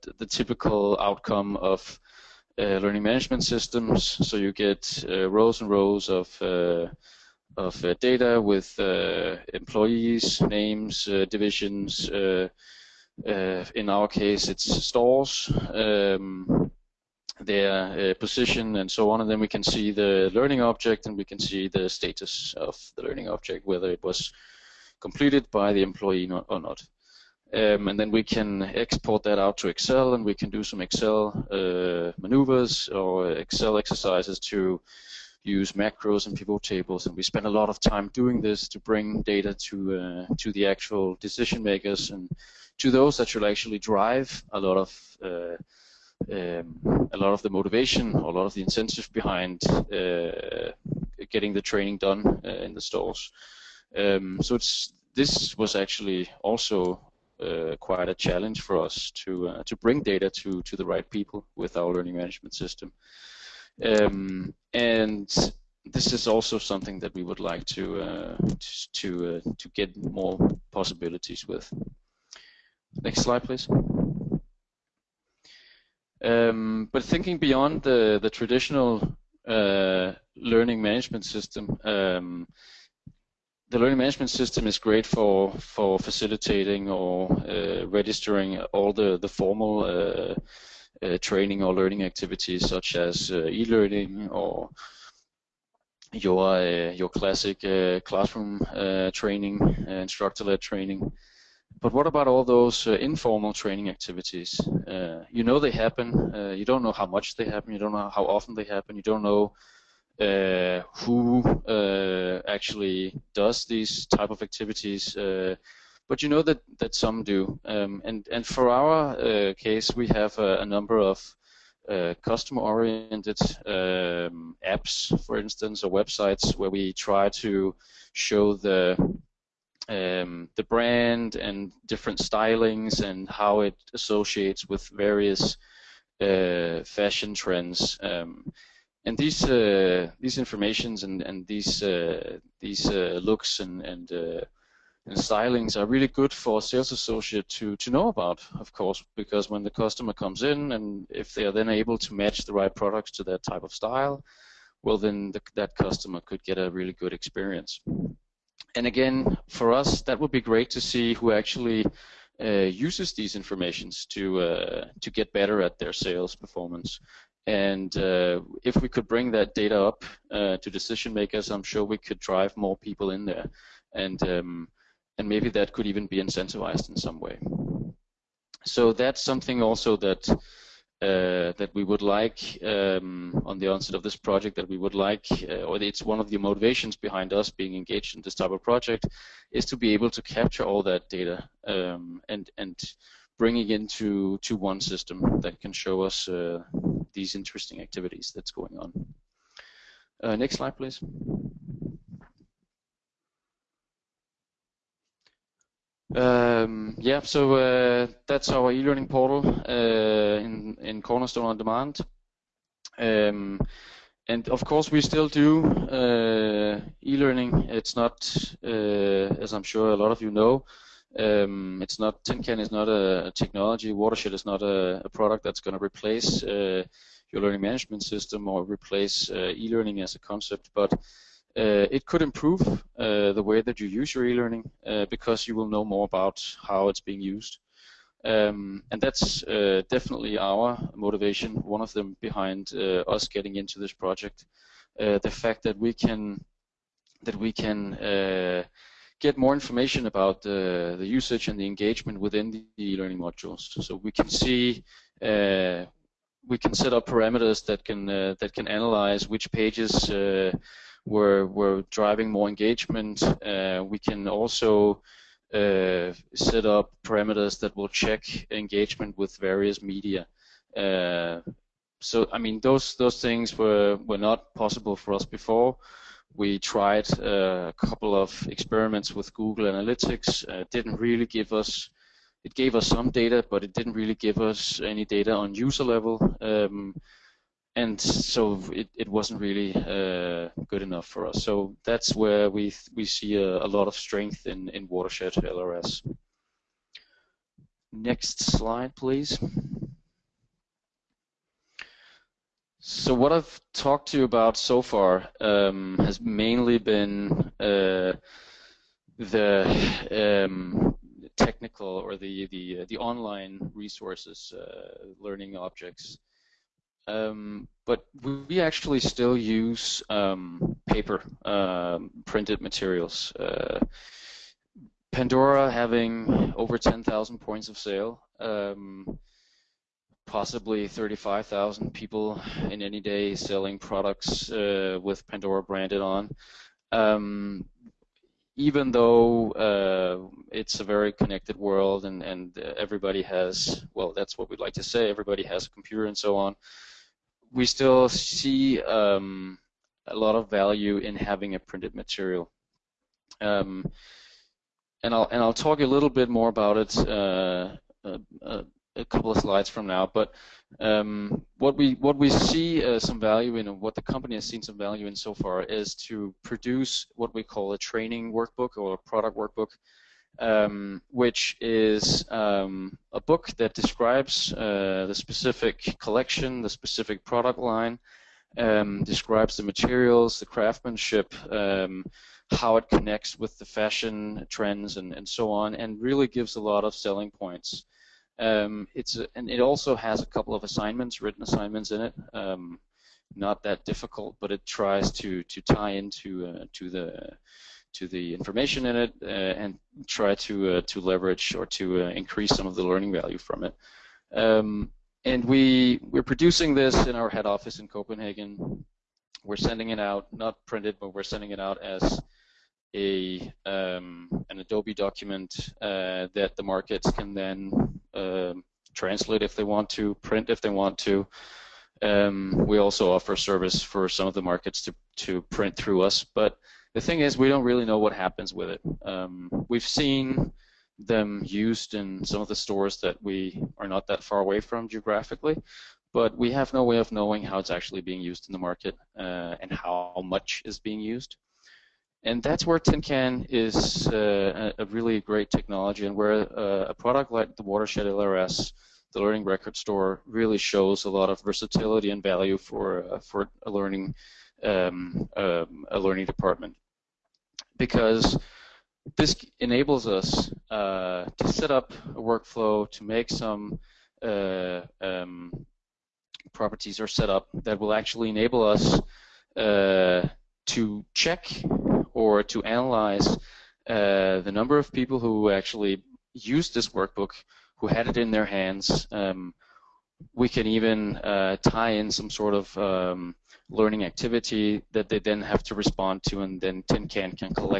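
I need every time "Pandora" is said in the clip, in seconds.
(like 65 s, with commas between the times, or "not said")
325 s, 335 s.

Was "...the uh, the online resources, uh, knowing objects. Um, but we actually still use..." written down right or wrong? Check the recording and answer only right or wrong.
wrong.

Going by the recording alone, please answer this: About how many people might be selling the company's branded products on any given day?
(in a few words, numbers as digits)
35,000.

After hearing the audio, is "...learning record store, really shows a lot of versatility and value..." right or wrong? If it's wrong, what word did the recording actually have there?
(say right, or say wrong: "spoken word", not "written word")
right.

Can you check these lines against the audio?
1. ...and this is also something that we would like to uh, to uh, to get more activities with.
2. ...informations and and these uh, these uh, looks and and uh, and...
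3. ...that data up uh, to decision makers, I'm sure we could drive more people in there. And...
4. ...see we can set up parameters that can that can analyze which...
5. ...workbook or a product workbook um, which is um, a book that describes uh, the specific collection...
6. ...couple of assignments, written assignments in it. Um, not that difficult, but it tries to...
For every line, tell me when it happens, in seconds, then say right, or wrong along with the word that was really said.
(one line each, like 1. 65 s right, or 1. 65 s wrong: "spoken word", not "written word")
1. 64 s wrong: "possibilities", not "activities"
2. 140 s right
3. 169 s right
4. 254 s right
5. 368 s right
6. 390 s right.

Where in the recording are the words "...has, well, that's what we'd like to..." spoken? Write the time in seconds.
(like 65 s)
343 s.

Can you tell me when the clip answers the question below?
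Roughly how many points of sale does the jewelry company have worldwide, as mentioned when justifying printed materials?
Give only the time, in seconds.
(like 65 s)
326 s.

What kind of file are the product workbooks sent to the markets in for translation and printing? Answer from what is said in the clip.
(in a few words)
Adobe document.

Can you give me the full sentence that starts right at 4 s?
So you get uh, rows and rows of of uh, data with uh, employees, names, uh, divisions.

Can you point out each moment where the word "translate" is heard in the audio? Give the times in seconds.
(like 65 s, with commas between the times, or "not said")
418 s.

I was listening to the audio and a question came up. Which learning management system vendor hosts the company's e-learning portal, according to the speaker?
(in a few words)
Cornerstone on Demand.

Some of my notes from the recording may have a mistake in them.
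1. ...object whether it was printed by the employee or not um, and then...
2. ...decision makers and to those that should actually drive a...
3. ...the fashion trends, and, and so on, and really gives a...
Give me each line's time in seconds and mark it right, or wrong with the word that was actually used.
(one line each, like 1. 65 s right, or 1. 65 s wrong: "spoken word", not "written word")
1. 23 s wrong: "completed", not "printed"
2. 41 s right
3. 383 s right.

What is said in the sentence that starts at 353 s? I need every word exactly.
Um, and I'll and I'll talk a little bit more about it uh, a, uh, uh, a, couple of slides from now.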